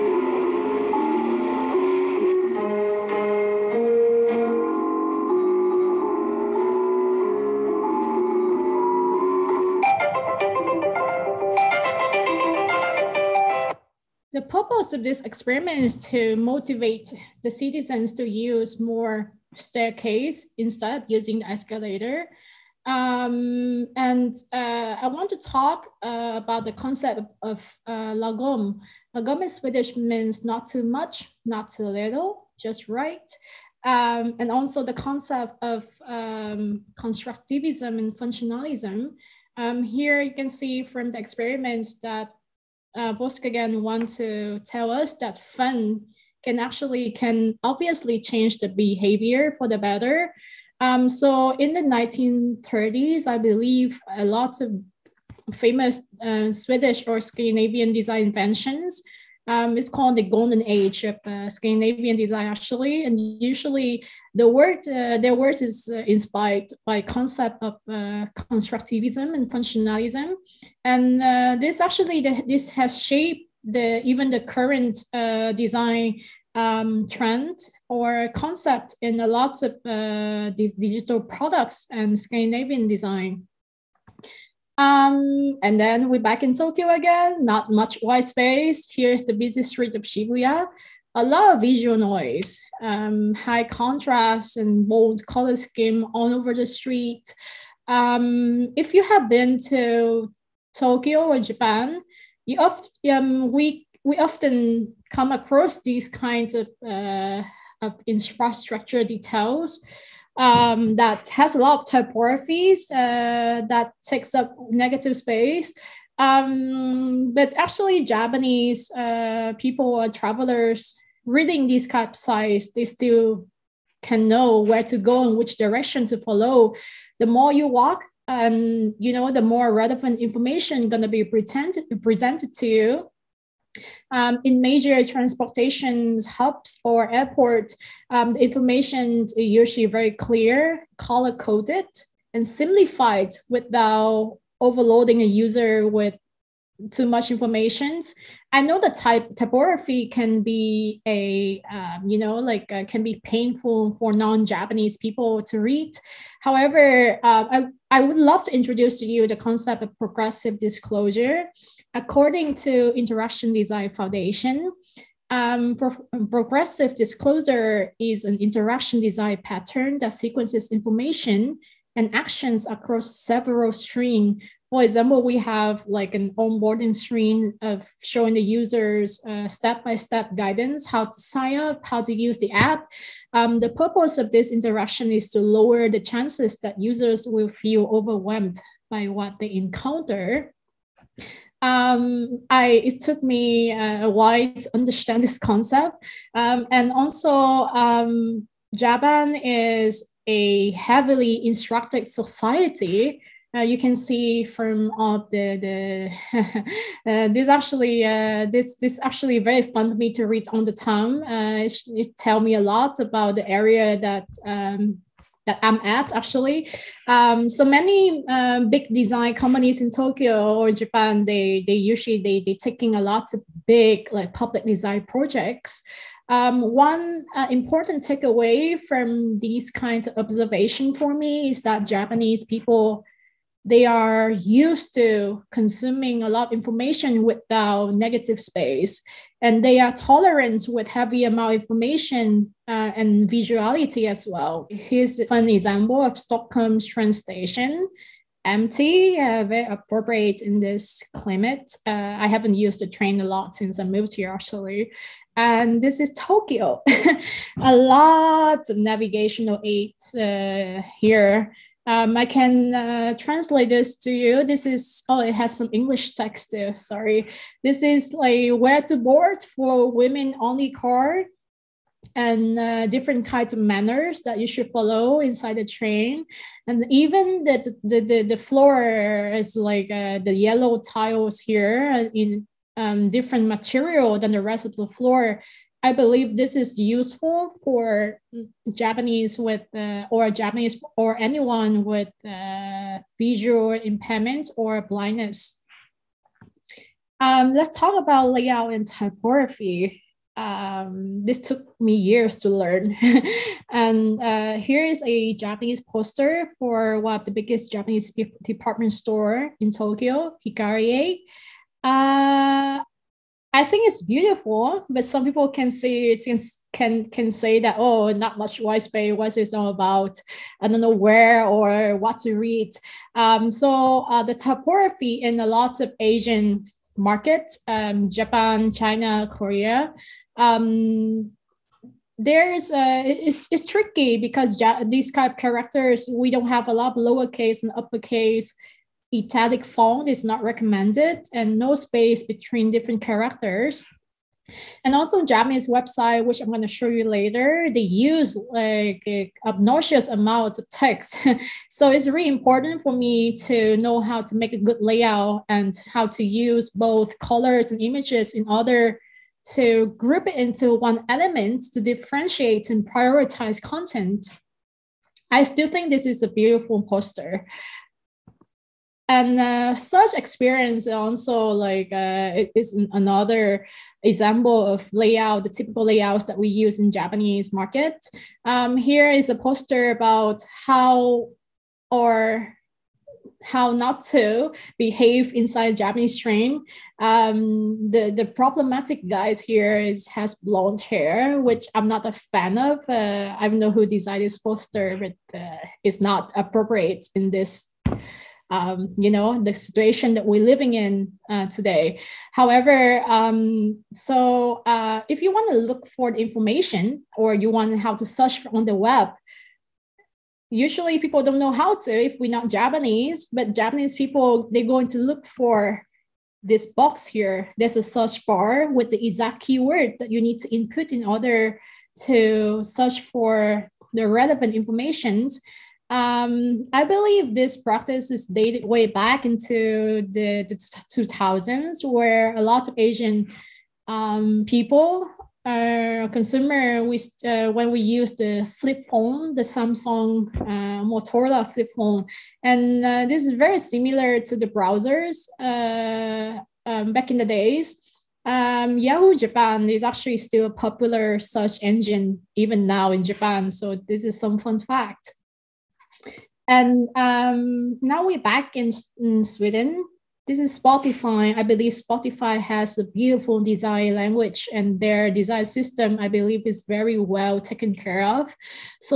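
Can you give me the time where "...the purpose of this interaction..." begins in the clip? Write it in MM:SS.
03:03.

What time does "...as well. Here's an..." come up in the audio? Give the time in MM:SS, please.
04:04.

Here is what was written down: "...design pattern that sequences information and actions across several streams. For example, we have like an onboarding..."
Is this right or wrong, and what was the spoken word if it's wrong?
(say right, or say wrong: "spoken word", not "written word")
right.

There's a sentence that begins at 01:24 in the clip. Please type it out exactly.
Um, and then we're back in Tokyo again, not much white space.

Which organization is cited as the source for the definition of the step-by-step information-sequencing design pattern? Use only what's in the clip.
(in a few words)
Interaction Design Foundation.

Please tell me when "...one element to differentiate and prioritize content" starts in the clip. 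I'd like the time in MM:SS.
06:00.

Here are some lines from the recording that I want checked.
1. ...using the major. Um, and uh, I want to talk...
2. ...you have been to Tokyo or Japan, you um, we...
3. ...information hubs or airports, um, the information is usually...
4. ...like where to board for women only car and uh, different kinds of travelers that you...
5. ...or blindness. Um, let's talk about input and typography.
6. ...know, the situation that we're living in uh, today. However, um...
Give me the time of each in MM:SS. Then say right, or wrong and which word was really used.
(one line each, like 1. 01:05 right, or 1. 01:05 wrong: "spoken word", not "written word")
1. 00:21 wrong: "escalator", not "major"
2. 01:38 right
3. 02:15 wrong: "transportation", not "information"
4. 04:28 wrong: "manners", not "travelers"
5. 04:54 wrong: "layout", not "input"
6. 06:39 right.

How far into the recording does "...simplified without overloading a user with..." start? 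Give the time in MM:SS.
02:22.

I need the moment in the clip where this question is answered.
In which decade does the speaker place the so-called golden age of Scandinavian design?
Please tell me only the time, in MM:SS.
00:51.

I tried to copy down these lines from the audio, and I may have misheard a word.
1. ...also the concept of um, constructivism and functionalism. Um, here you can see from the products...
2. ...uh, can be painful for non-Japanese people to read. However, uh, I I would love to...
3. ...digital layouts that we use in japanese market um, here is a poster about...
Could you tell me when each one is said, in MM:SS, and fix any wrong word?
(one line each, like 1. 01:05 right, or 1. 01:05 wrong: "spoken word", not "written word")
1. 00:34 wrong: "experiments", not "products"
2. 02:32 right
3. 06:15 wrong: "typical", not "digital".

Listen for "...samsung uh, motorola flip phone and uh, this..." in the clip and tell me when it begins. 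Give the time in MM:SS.
07:19.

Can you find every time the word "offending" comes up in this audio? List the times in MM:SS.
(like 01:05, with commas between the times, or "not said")
not said.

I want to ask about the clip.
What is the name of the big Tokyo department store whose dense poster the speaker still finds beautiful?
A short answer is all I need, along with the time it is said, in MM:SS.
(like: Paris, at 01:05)
Hikarie, at 05:10.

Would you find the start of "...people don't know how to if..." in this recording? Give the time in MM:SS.
06:50.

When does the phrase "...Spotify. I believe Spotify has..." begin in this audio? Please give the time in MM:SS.
07:40.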